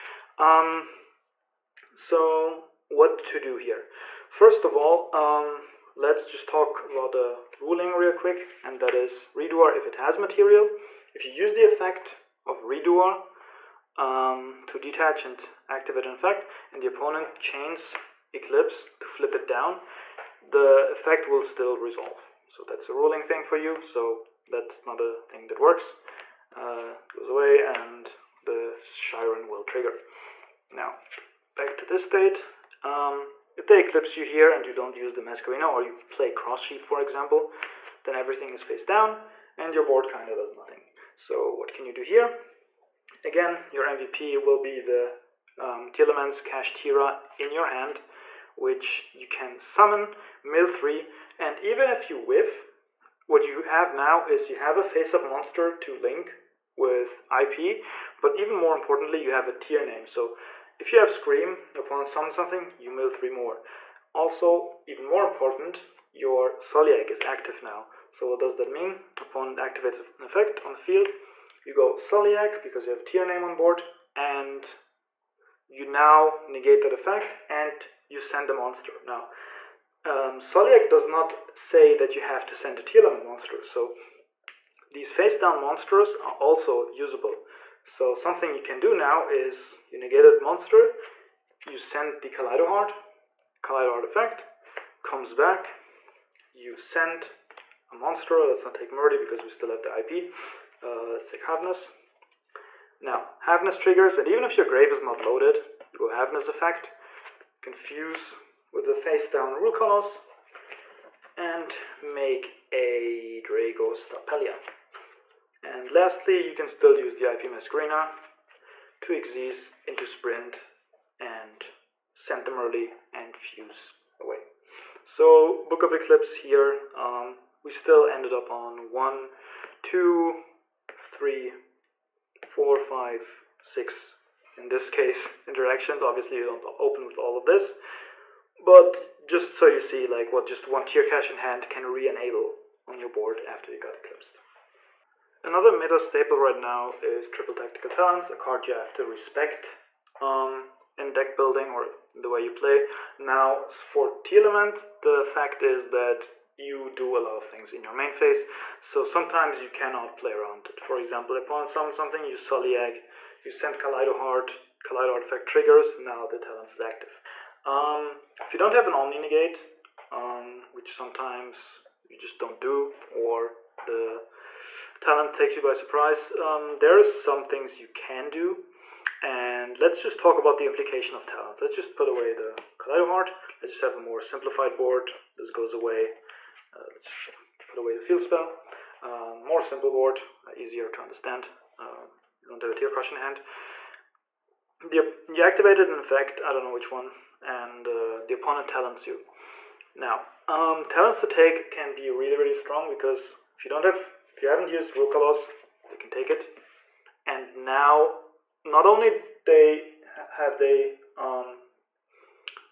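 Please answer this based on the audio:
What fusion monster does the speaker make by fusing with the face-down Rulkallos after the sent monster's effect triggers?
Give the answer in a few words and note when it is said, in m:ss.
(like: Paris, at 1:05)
Drago Stapelia, at 1:53.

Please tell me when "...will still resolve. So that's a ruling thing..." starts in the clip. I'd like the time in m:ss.
0:21.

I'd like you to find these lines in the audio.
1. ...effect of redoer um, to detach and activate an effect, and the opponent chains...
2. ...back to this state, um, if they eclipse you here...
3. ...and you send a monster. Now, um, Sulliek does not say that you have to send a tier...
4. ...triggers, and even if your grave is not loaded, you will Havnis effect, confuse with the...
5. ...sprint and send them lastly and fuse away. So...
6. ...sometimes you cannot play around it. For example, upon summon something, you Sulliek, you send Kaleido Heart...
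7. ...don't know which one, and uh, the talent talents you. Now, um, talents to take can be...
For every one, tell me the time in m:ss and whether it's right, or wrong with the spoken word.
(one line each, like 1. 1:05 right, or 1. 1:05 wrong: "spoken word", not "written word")
1. 0:11 right
2. 0:31 right
3. 1:17 right
4. 1:43 right
5. 2:00 wrong: "early", not "lastly"
6. 2:39 right
7. 3:16 wrong: "opponent", not "talent".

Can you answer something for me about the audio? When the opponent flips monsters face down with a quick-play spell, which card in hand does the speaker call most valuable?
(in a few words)
Tearlaments Kashtira.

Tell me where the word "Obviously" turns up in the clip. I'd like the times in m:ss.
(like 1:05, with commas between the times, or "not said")
2:16.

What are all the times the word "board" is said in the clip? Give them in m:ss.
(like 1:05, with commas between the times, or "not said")
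0:39, 1:13, 2:23, 3:04, 3:09.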